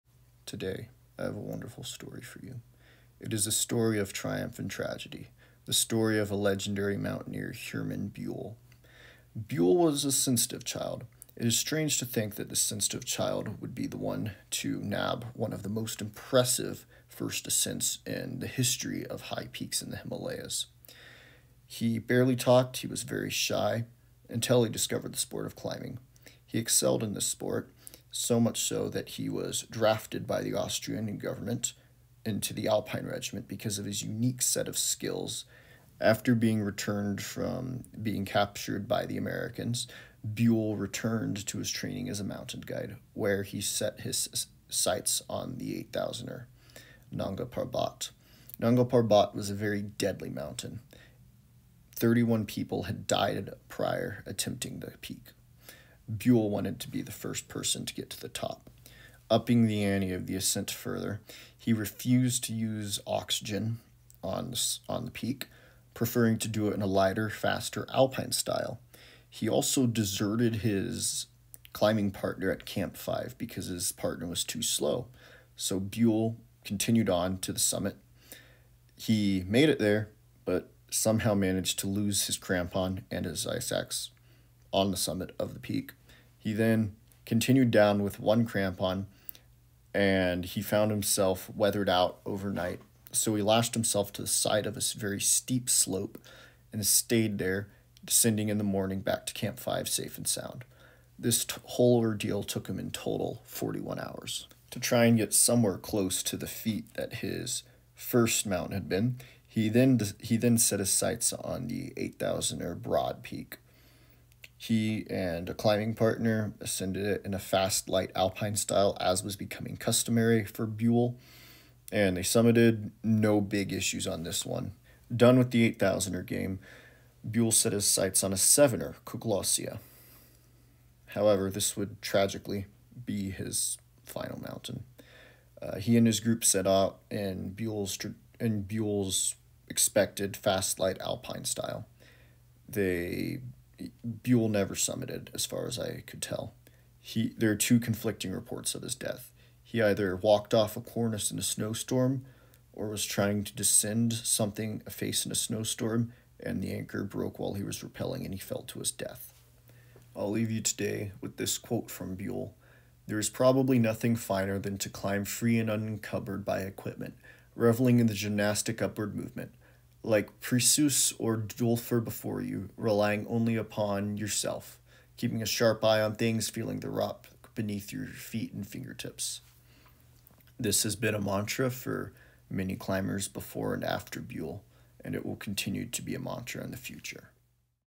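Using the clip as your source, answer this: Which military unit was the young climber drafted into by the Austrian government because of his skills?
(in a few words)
Alpine Regiment.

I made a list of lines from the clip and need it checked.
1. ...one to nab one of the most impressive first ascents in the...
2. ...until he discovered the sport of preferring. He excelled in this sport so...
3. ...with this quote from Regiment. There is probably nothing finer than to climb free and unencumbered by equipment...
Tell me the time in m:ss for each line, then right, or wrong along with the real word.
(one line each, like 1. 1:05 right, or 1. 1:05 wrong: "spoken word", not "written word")
1. 0:13 right
2. 0:24 wrong: "climbing", not "preferring"
3. 2:41 wrong: "Buhl", not "Regiment".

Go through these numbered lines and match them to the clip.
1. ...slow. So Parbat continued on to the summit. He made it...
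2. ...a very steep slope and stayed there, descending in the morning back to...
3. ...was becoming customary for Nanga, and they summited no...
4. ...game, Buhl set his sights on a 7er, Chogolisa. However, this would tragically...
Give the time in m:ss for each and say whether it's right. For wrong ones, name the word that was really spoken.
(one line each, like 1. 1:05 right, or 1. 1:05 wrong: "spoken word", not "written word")
1. 1:14 wrong: "Buhl", not "Parbat"
2. 1:34 right
3. 1:59 wrong: "Buhl", not "Nanga"
4. 2:06 right.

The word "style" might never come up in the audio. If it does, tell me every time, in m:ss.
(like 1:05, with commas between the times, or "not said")
1:08, 1:58, 2:21.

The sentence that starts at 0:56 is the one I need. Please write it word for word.
Buhl wanted to be the first person to get to the top, upping the ante of the ascent further.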